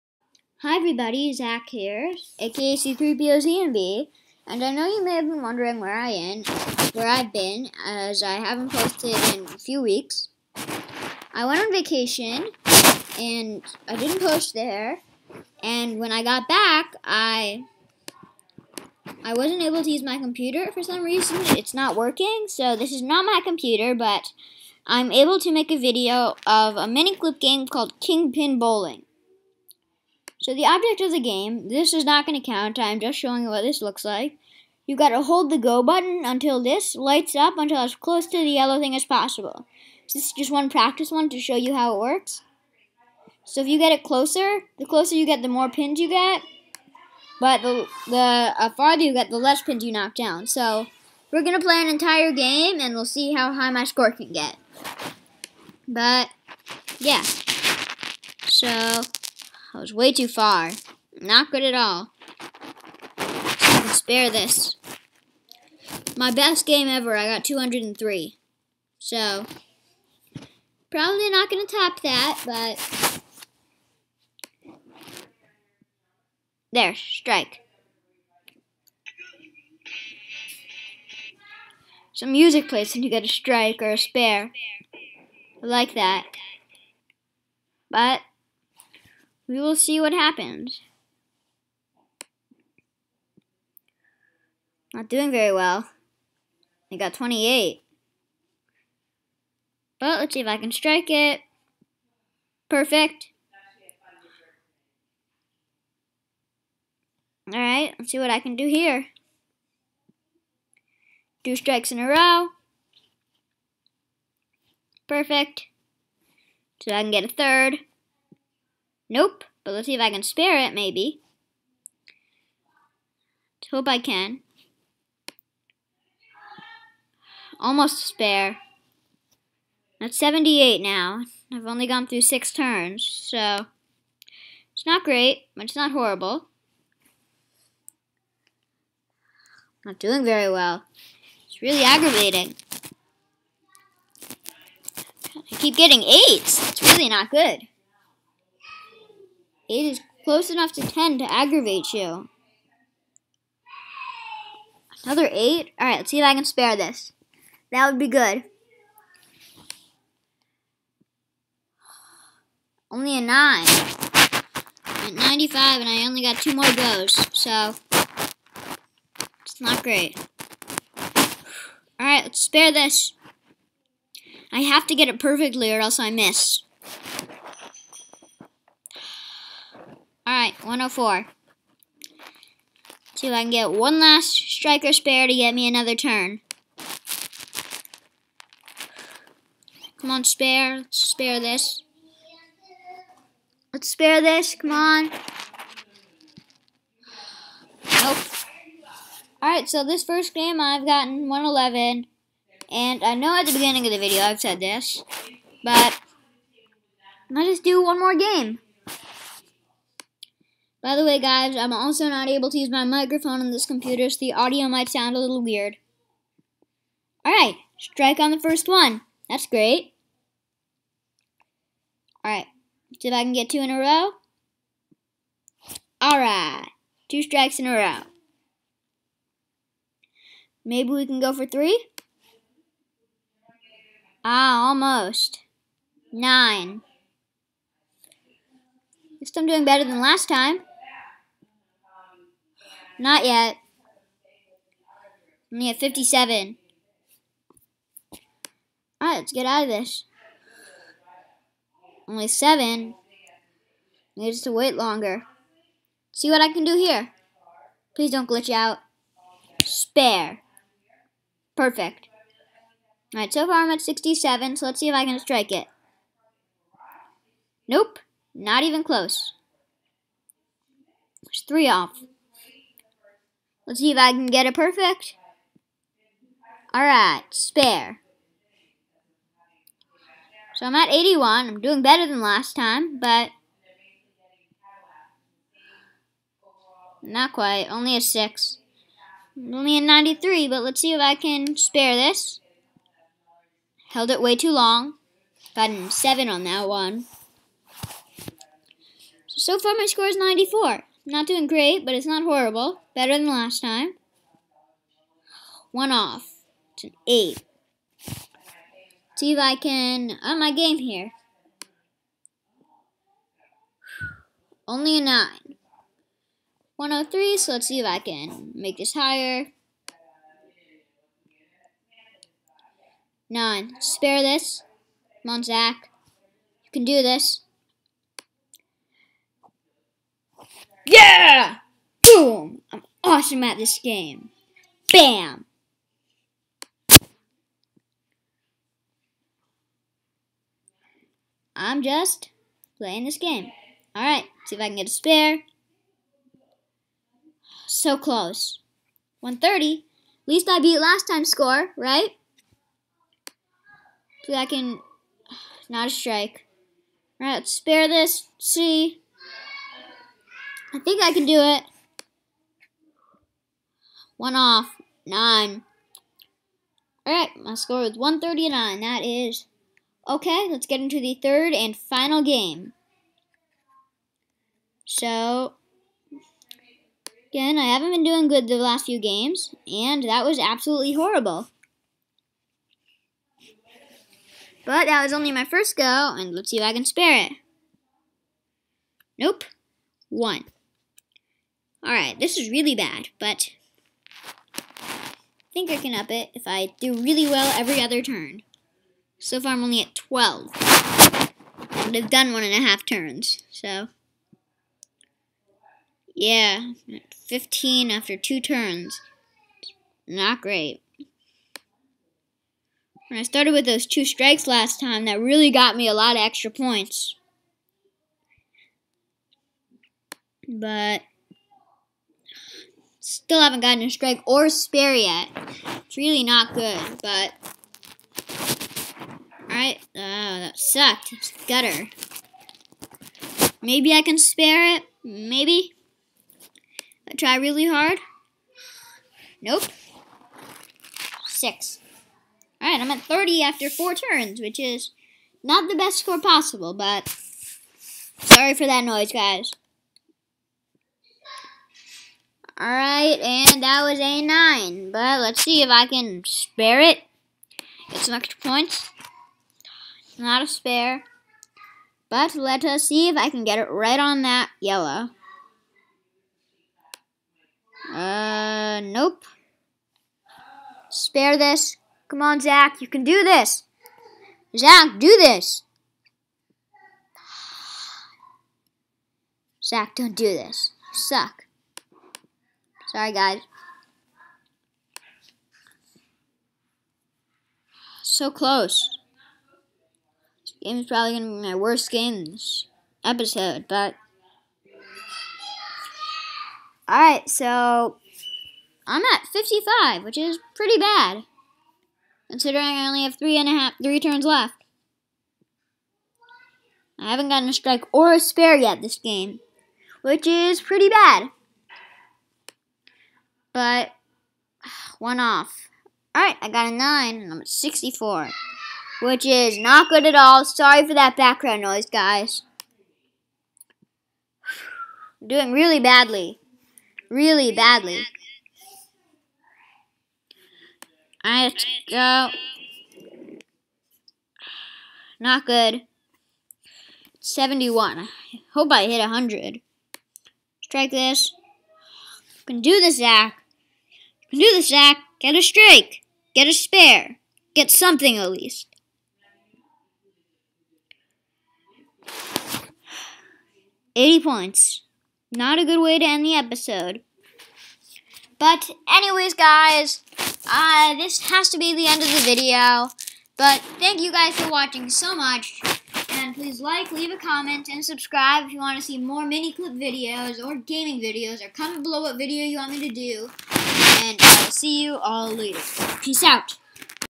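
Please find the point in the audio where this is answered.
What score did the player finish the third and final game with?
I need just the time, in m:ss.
9:13.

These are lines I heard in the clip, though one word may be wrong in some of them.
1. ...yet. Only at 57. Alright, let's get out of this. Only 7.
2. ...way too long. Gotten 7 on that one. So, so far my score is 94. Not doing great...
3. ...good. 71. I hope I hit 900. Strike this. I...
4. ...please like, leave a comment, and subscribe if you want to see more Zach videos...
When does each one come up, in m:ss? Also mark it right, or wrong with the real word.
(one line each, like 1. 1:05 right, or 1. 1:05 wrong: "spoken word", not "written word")
1. 4:03 right
2. 4:54 right
3. 8:55 wrong: "100", not "900"
4. 9:26 wrong: "Miniclip", not "Zach".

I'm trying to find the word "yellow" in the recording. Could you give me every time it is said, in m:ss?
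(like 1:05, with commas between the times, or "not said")
0:38, 7:44.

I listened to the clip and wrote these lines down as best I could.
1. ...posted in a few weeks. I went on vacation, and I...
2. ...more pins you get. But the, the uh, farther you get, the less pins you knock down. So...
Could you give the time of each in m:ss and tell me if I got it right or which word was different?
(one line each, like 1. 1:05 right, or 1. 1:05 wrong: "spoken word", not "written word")
1. 0:08 right
2. 0:45 right.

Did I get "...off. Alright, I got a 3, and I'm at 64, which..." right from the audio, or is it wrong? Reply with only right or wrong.
wrong.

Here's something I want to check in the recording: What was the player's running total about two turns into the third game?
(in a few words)
15.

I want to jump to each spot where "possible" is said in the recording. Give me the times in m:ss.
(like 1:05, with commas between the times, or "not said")
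0:39, 7:26.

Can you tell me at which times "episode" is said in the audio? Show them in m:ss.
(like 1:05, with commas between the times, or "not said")
8:13, 9:16.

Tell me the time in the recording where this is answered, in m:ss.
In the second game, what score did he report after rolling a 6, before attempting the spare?
4:49.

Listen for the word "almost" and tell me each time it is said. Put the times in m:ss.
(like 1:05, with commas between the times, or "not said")
2:07, 3:54.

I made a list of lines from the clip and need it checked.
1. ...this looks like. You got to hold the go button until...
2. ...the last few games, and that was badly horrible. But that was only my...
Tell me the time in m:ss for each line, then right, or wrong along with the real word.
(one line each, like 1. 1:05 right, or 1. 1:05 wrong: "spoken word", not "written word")
1. 0:33 right
2. 6:18 wrong: "absolutely", not "badly".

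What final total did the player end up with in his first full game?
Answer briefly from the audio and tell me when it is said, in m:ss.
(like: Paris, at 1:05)
111, at 3:21.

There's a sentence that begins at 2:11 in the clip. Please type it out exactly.
I've only gone through six turns, so...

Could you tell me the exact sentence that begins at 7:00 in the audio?
But Still haven't gotten a strike or spare yet.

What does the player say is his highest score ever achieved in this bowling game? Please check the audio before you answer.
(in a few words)
203.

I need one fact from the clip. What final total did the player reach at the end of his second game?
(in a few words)
139.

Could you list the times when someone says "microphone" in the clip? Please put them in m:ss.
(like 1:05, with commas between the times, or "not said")
3:32.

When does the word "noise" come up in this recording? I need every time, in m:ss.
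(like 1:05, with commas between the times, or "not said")
7:28, 8:41.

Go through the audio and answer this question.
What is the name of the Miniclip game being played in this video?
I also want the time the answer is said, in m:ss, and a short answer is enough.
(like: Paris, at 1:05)
Kingpin Bowling, at 0:27.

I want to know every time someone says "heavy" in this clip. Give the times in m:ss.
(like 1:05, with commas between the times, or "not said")
not said.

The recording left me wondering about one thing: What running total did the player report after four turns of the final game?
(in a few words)
30.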